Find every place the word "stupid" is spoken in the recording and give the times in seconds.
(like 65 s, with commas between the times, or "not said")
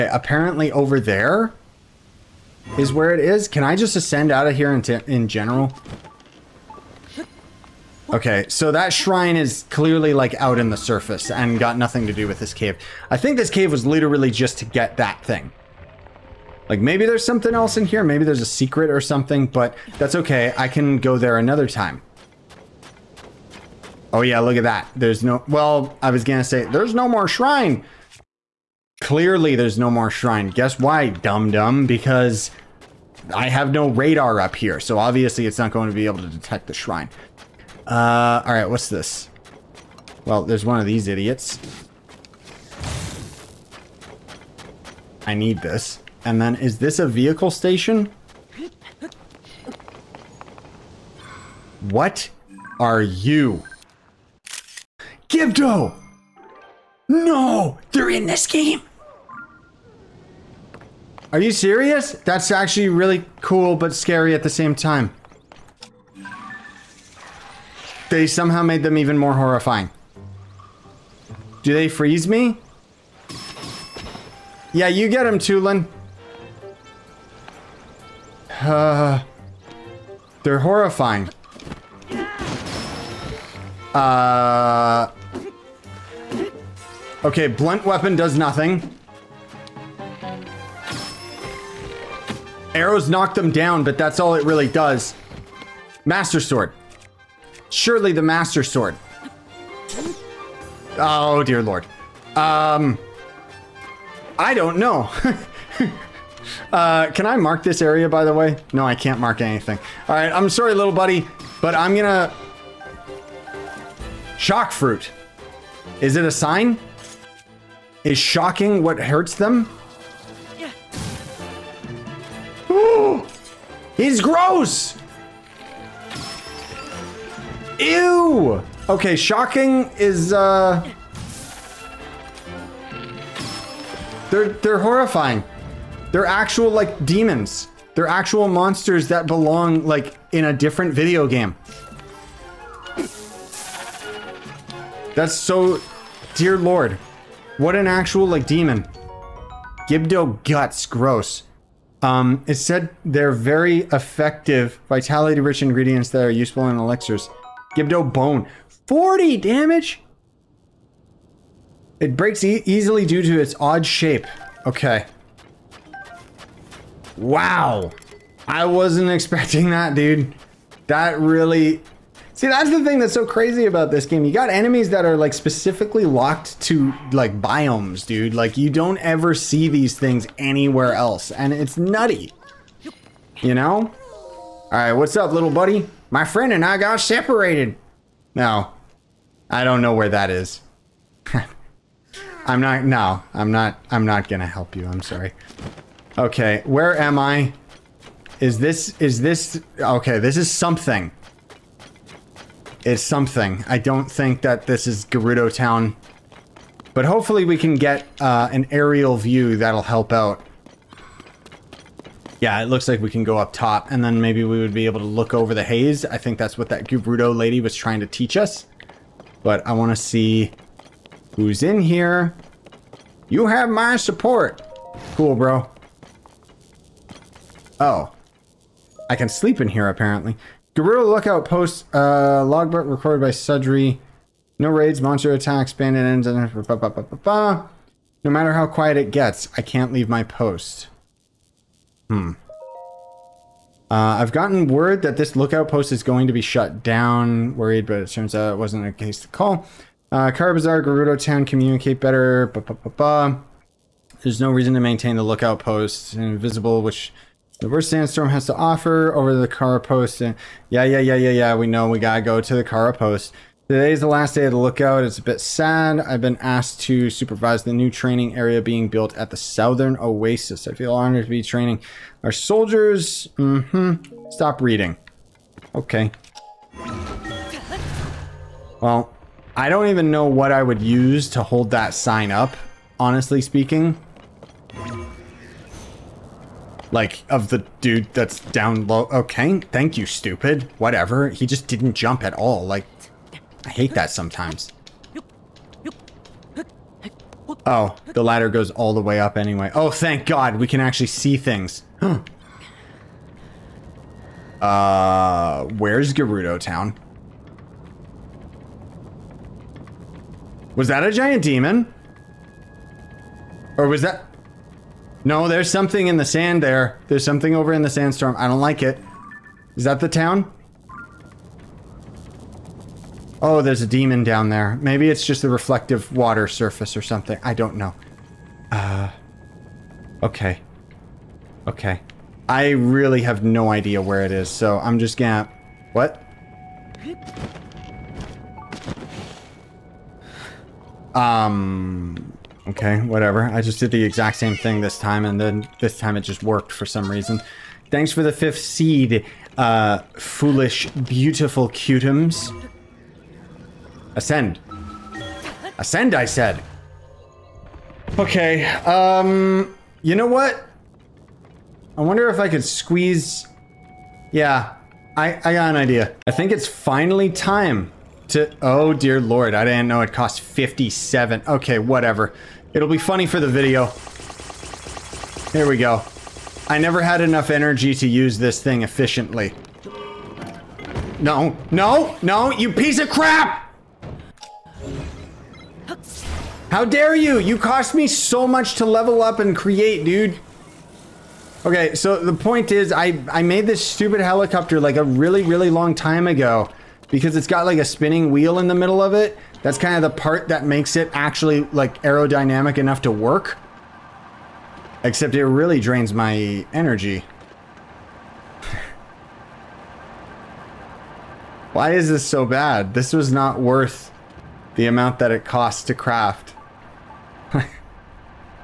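290 s, 393 s.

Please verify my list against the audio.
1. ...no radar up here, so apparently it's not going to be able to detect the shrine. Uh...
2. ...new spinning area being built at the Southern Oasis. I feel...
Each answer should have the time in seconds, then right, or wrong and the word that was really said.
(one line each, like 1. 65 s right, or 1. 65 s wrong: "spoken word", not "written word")
1. 33 s wrong: "obviously", not "apparently"
2. 267 s wrong: "training", not "spinning".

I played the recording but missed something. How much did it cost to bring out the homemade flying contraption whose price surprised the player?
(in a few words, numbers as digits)
57.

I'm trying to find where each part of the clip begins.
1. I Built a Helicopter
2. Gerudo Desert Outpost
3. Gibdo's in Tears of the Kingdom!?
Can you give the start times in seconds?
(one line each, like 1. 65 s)
1. 365 s
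2. 195 s
3. 44 s.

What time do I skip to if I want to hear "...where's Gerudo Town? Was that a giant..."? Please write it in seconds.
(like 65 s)
305 s.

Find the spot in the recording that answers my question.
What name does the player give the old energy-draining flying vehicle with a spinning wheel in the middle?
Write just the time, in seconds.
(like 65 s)
394 s.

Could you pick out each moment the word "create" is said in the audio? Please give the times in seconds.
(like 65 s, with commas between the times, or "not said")
389 s.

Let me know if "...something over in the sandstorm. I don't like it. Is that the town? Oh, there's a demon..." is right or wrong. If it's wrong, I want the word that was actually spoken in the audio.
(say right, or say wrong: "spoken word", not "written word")
right.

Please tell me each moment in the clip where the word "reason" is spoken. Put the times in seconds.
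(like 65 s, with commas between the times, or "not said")
254 s, 347 s.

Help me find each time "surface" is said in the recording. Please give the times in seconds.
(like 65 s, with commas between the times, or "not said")
10 s, 326 s.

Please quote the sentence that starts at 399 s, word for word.
That's kind of the part that makes it actually like aerodynamic enough to work.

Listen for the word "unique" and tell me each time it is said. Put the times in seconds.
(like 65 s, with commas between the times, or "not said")
not said.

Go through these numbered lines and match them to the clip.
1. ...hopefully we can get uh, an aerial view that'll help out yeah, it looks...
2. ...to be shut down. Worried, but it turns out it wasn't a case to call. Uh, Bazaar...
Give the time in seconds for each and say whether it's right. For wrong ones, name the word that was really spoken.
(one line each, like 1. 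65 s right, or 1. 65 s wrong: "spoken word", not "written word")
1. 207 s right
2. 246 s right.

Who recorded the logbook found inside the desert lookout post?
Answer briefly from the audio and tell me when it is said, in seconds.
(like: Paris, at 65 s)
Sudri, at 233 s.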